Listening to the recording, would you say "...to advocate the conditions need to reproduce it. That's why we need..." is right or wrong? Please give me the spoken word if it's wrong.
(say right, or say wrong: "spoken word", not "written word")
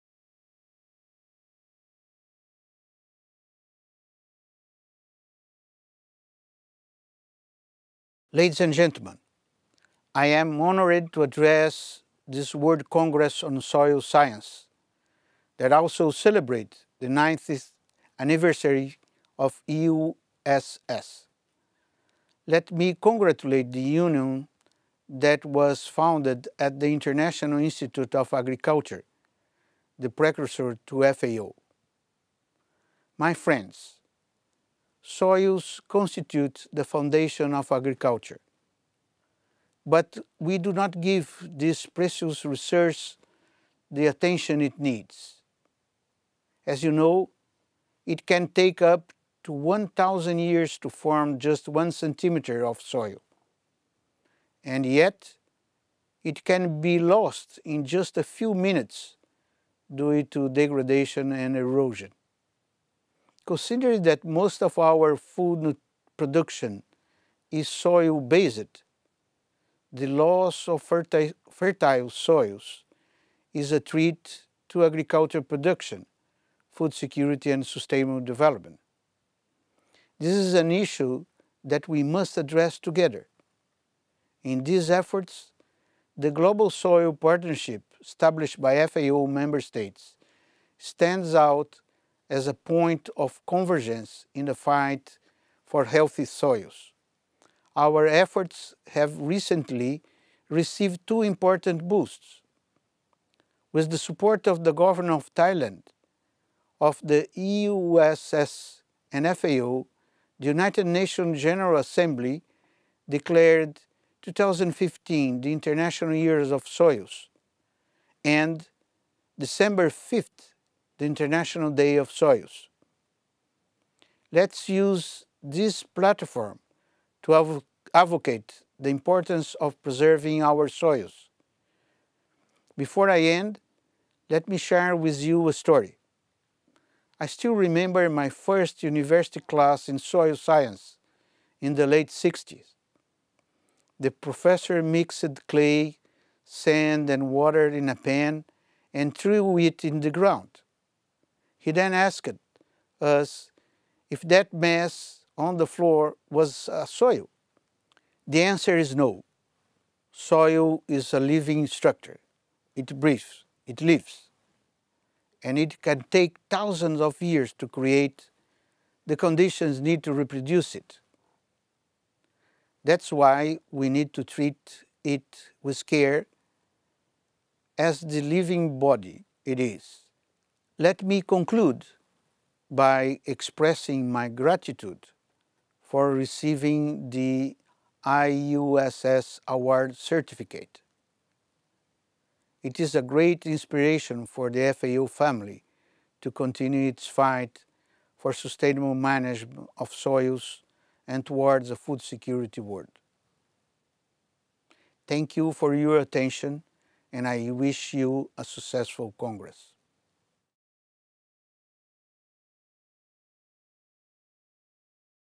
wrong: "create", not "advocate".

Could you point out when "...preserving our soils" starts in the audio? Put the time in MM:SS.
02:09.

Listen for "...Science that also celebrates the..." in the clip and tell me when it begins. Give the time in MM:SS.
00:13.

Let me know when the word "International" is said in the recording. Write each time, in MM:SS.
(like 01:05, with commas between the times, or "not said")
00:26, 01:55, 02:01.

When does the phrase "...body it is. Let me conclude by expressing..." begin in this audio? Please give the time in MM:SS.
02:58.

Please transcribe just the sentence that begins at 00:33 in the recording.
My friends, soils constitute the foundation of agriculture.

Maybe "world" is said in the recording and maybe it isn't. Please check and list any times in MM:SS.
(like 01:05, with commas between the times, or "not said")
00:12, 03:22.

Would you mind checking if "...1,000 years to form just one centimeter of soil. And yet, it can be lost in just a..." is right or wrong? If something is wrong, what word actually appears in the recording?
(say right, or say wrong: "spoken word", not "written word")
right.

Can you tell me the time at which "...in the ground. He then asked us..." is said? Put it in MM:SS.
02:29.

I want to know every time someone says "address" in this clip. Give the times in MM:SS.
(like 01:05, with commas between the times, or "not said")
00:11, 01:22.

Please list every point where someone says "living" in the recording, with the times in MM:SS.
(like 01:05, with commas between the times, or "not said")
02:41, 02:58.